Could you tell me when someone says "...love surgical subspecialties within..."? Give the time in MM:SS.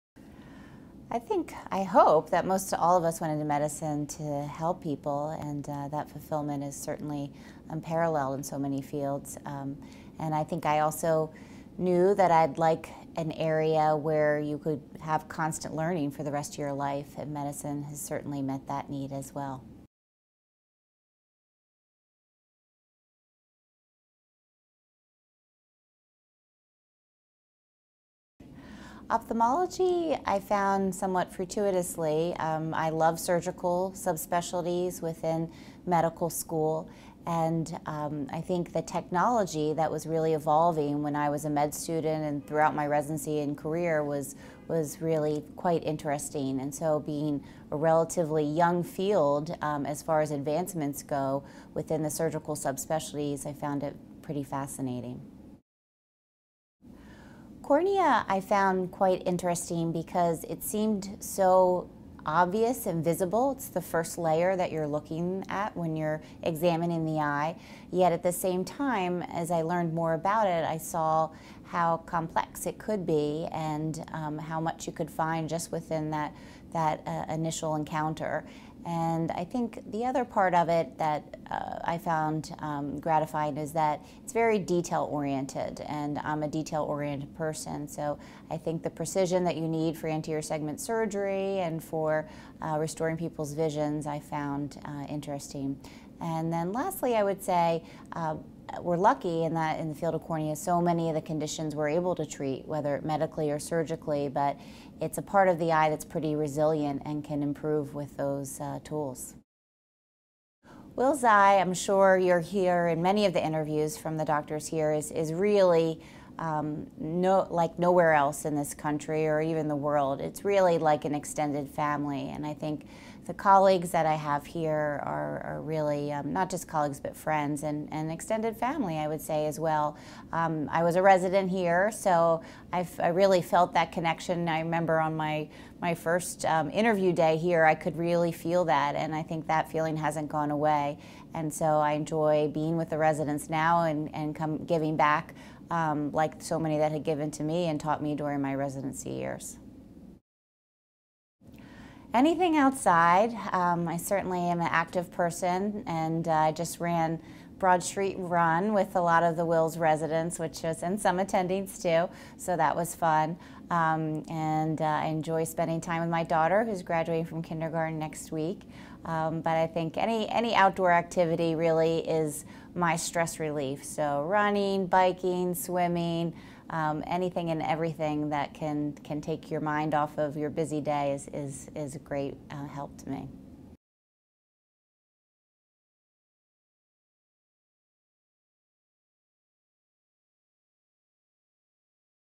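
00:32.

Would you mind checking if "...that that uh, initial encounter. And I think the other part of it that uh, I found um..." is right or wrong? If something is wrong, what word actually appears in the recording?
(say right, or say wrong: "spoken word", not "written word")
right.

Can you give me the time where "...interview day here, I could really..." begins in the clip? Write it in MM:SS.
02:16.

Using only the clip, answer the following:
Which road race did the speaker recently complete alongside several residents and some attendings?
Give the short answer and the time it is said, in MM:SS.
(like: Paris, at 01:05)
Broad Street Run, at 02:37.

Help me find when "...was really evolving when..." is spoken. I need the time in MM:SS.
00:39.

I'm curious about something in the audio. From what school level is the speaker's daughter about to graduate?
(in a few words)
Kindergarten.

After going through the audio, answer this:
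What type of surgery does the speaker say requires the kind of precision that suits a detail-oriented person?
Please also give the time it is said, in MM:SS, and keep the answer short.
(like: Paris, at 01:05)
Anterior segment surgery, at 01:30.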